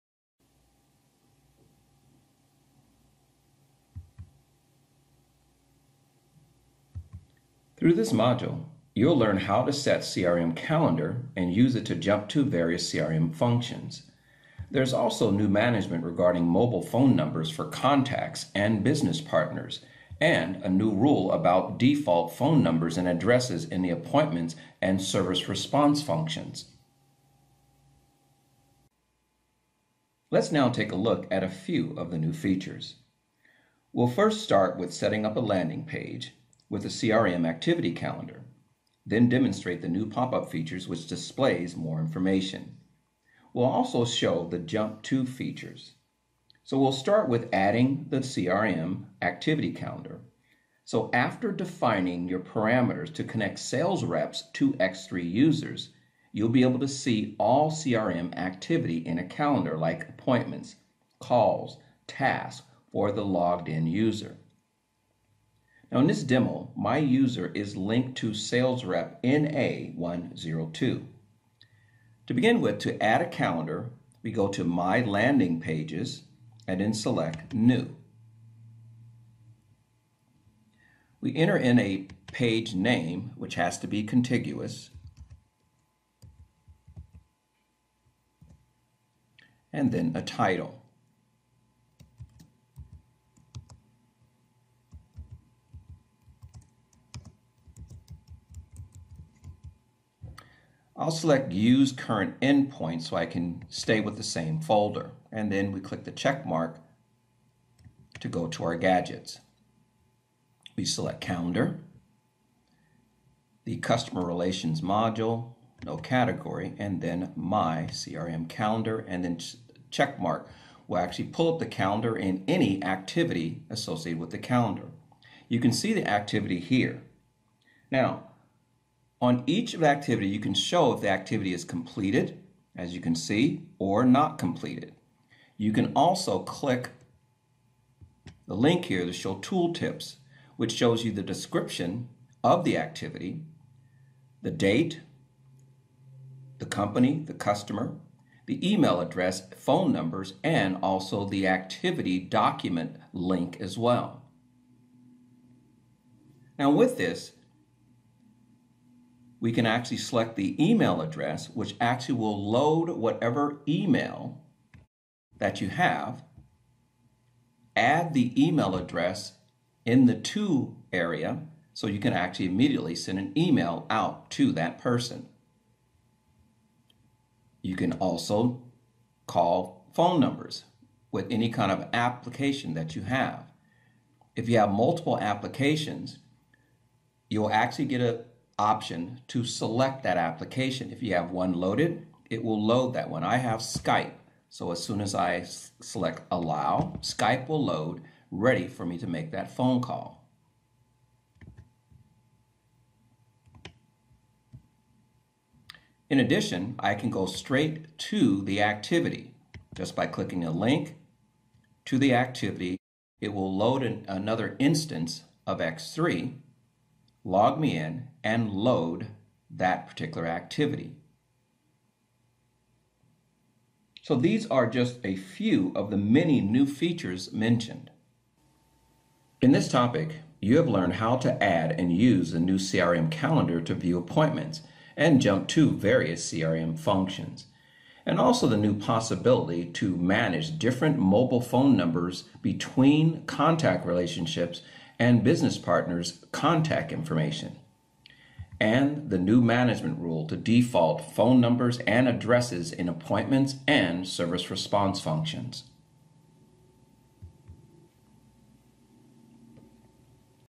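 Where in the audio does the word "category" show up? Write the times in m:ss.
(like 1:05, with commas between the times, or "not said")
1:55.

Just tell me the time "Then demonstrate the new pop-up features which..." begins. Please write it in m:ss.
0:39.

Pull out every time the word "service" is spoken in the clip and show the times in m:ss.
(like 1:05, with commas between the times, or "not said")
0:25, 4:14.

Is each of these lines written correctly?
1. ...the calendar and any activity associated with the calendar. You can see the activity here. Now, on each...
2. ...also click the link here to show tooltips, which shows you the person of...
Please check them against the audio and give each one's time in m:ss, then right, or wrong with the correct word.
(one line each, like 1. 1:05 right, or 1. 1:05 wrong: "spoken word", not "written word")
1. 2:01 right
2. 2:15 wrong: "description", not "person".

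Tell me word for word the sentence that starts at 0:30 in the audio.
Let's now take a look at a few of the new features.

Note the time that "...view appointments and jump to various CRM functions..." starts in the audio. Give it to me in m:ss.
3:53.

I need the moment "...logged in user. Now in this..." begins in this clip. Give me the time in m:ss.
1:03.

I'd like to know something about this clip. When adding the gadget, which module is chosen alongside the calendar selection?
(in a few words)
Customer Relations.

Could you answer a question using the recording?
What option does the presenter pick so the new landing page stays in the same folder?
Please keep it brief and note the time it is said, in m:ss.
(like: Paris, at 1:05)
Use Current Endpoint, at 1:41.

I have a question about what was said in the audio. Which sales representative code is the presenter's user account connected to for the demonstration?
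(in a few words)
NA102.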